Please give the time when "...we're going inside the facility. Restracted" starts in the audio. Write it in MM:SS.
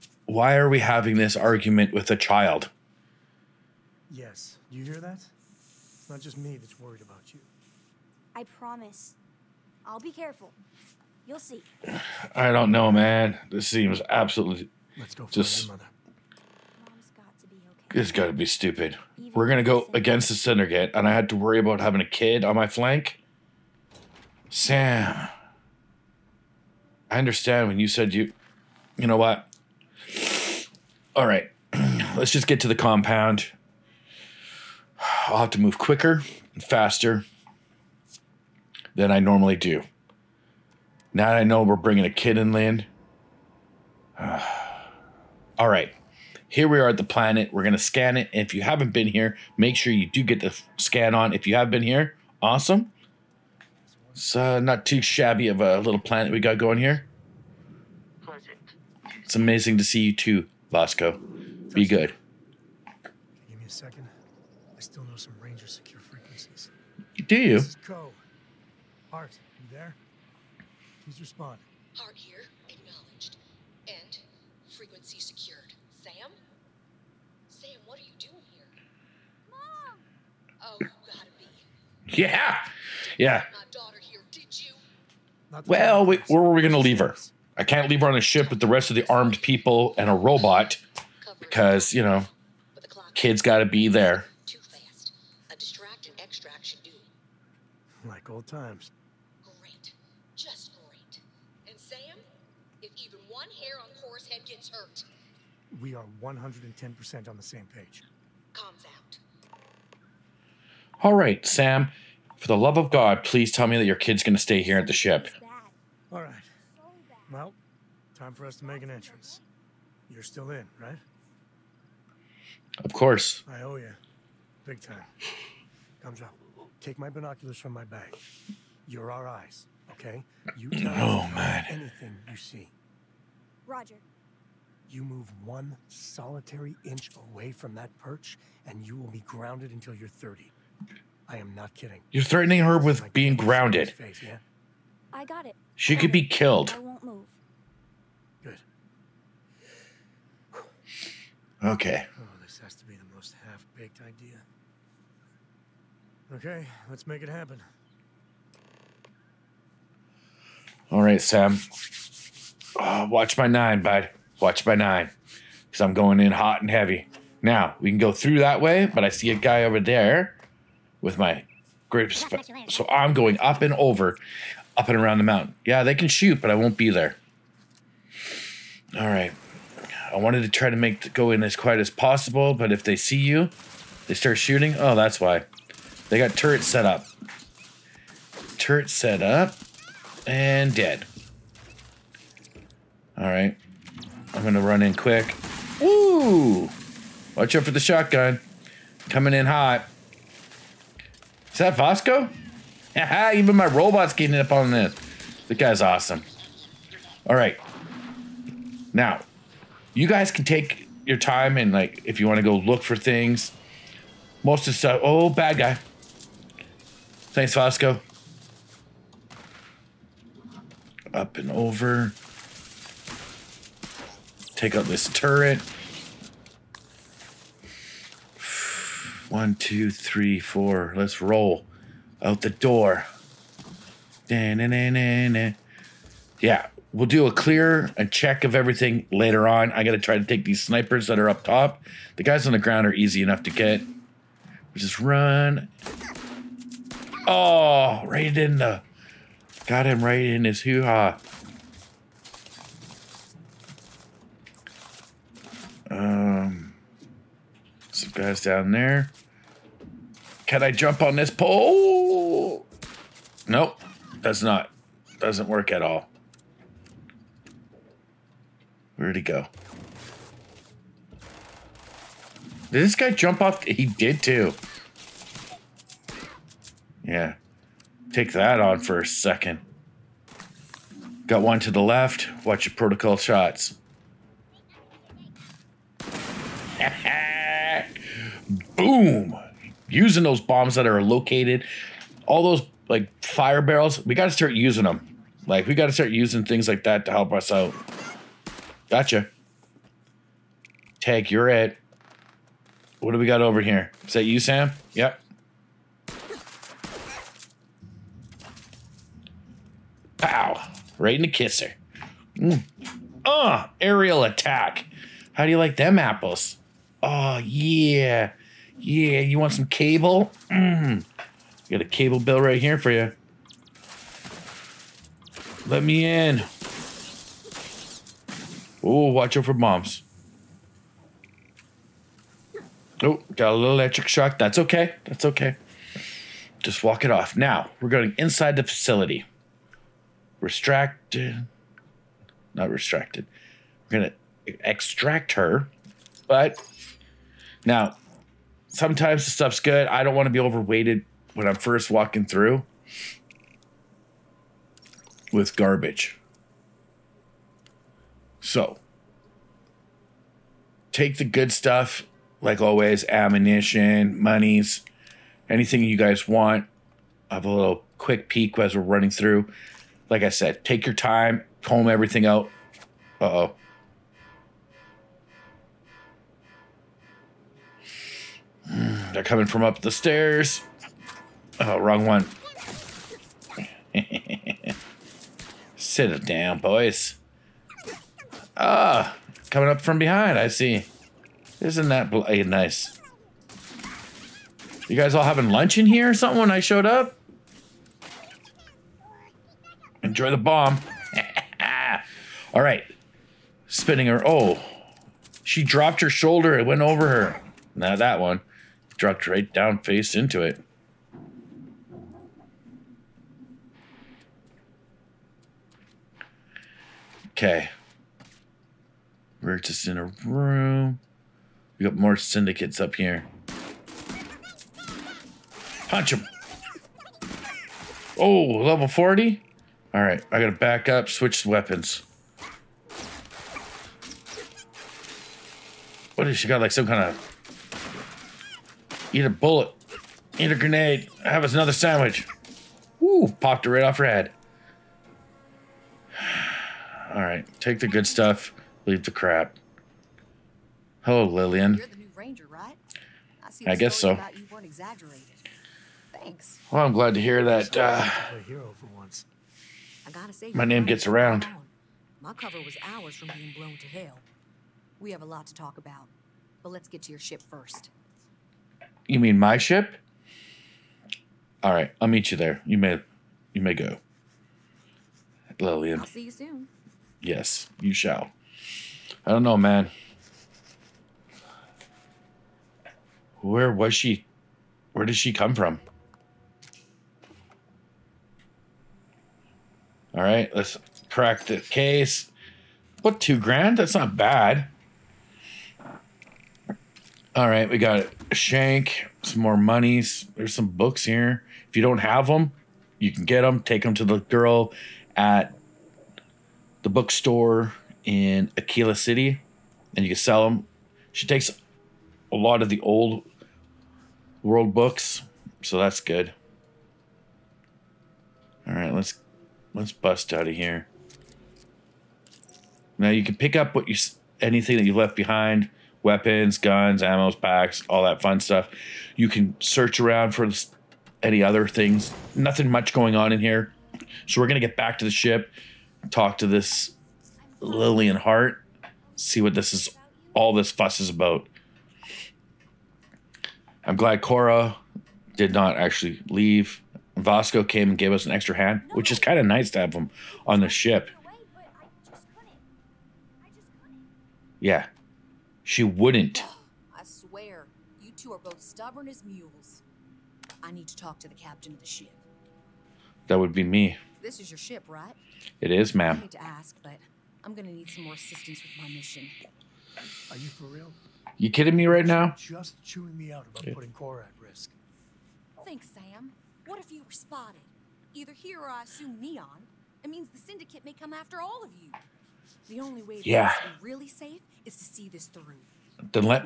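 05:37.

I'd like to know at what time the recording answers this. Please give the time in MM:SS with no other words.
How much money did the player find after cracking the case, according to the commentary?
08:13.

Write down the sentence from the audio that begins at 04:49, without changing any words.
boom, using those bombs that are located, all those like fire barrels.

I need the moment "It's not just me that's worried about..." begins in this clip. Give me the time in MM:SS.
00:05.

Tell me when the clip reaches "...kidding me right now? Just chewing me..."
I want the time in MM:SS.
09:31.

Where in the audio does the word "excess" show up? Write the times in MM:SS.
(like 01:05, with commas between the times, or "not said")
not said.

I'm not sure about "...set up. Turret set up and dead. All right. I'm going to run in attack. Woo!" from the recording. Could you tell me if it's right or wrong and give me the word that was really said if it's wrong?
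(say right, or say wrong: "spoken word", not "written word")
wrong: "quick", not "attack".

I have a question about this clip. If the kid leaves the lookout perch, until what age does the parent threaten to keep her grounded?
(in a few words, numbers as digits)
30.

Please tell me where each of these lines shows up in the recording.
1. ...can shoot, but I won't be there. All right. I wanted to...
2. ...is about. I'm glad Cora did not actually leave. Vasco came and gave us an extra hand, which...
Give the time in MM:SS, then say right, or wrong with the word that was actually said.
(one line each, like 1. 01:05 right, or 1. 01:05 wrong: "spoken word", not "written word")
1. 02:55 right
2. 09:01 right.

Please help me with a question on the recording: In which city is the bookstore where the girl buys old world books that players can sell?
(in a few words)
Akila City.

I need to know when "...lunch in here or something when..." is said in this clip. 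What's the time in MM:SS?
06:35.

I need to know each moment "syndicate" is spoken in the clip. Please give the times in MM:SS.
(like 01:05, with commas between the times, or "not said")
00:20, 07:02, 09:40.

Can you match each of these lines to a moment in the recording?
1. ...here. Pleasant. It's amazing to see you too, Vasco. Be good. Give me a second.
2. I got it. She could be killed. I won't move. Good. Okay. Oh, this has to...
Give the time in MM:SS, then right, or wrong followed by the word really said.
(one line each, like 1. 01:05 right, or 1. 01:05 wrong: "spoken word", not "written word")
1. 00:56 right
2. 02:25 right.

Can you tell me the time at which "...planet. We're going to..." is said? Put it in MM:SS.
00:47.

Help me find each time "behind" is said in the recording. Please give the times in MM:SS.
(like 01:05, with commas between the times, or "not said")
06:29, 08:45.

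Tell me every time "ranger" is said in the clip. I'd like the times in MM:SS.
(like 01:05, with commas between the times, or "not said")
01:05, 07:32.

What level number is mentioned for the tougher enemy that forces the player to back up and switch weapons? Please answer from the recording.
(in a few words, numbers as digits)
40.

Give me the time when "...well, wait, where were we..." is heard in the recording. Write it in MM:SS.
01:25.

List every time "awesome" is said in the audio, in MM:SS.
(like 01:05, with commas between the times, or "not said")
00:52, 03:25.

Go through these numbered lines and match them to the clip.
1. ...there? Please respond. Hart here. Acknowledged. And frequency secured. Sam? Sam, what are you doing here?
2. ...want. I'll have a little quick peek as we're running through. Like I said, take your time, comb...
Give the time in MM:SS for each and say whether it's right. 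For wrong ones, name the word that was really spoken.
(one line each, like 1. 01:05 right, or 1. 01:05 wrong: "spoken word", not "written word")
1. 01:09 right
2. 06:06 right.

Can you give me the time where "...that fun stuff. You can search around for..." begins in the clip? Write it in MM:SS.
08:48.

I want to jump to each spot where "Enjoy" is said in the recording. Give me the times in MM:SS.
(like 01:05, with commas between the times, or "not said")
06:40.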